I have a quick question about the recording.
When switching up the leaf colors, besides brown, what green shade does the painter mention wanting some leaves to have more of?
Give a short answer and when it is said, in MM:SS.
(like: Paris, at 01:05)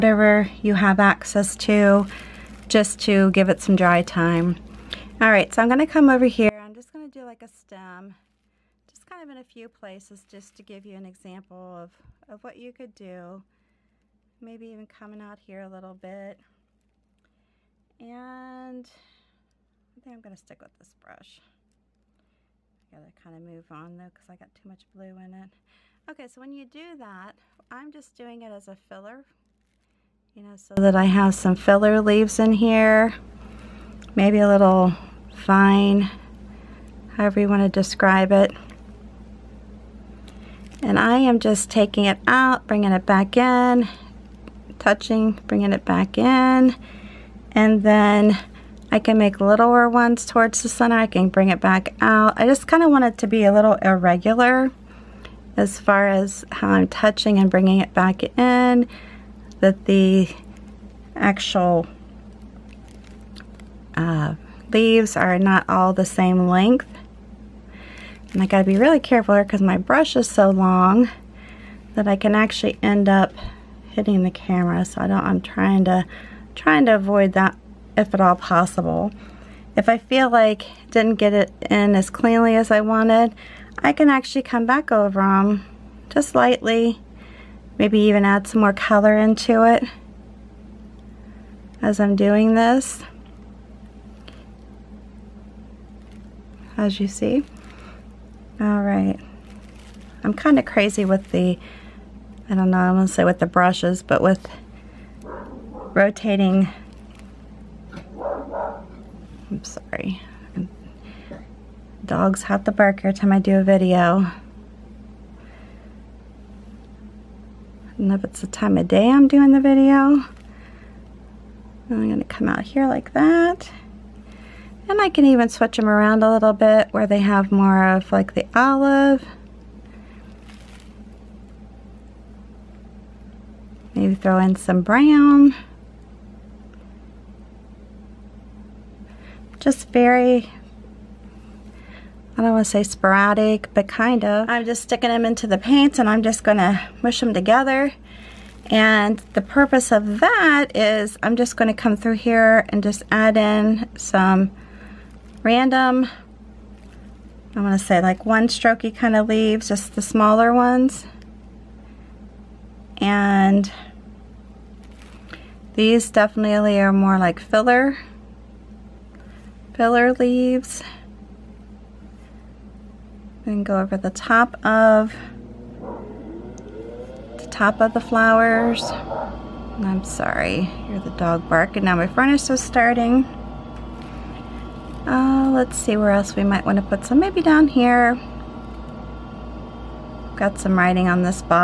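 olive, at 02:08.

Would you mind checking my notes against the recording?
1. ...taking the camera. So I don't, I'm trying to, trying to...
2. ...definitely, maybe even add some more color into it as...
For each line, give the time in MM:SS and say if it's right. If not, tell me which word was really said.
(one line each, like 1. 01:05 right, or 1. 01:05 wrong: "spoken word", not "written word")
1. 01:13 wrong: "hitting", not "taking"
2. 01:26 wrong: "lightly", not "definitely".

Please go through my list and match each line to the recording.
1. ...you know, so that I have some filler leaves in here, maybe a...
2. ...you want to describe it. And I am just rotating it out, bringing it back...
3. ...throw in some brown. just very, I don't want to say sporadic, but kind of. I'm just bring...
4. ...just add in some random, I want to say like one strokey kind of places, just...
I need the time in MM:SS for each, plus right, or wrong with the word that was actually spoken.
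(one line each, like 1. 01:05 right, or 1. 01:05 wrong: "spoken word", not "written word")
1. 00:30 right
2. 00:37 wrong: "taking", not "rotating"
3. 02:14 wrong: "sticking", not "bring"
4. 02:32 wrong: "leaves", not "places".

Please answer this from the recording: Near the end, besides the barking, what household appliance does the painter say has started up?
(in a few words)
furnace.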